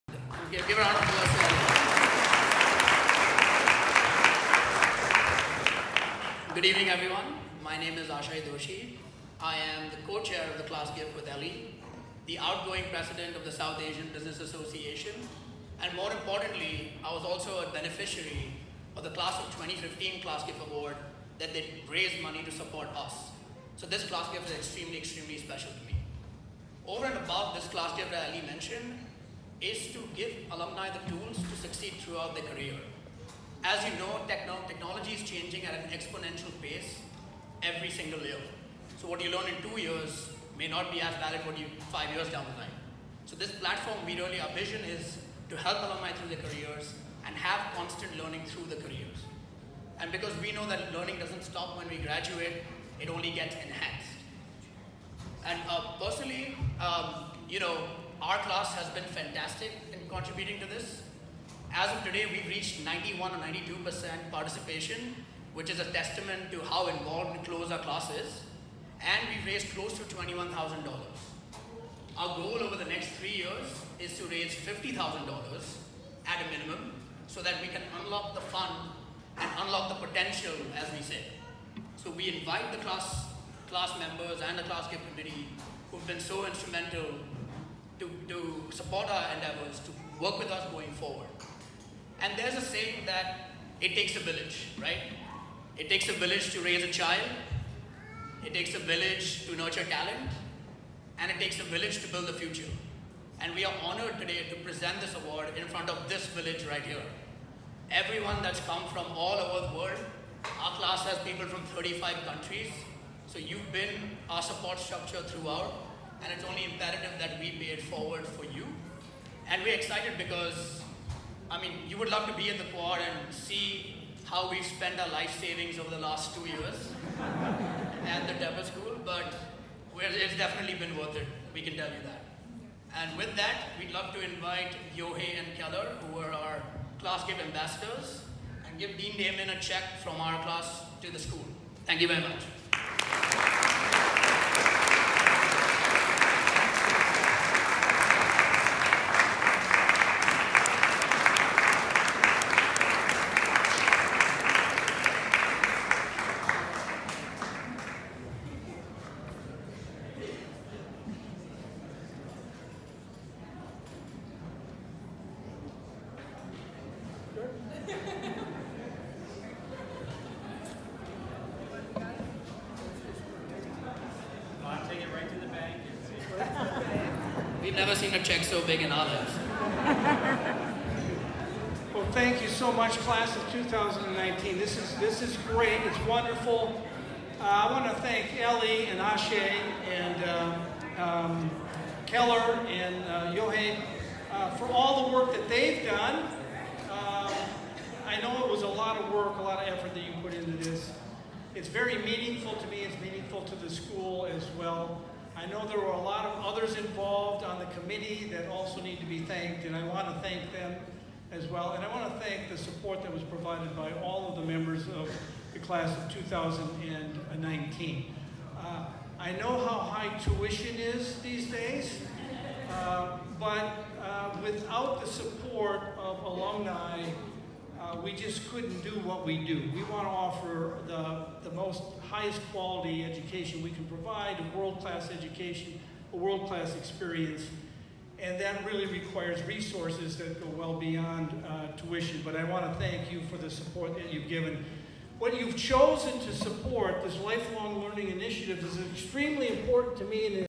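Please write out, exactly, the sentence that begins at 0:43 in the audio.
So this platform, we really, our vision is to help alumni through their careers and have constant learning through the careers.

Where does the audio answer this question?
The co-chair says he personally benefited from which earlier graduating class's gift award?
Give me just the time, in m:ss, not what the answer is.
0:19.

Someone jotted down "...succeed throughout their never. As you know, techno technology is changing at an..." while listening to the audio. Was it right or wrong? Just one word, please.
wrong.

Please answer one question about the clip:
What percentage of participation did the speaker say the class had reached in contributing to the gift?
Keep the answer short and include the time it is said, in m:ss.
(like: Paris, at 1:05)
91 or 92%, at 1:02.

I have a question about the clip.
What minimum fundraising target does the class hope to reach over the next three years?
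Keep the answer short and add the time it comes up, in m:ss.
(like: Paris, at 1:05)
$50,000, at 1:14.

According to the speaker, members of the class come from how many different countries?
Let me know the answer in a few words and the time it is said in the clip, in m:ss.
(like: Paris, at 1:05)
35, at 1:51.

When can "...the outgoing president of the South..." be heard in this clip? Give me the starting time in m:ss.
0:12.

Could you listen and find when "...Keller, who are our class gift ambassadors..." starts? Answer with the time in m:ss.
2:15.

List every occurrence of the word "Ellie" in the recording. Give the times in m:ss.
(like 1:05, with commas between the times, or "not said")
0:11, 3:08.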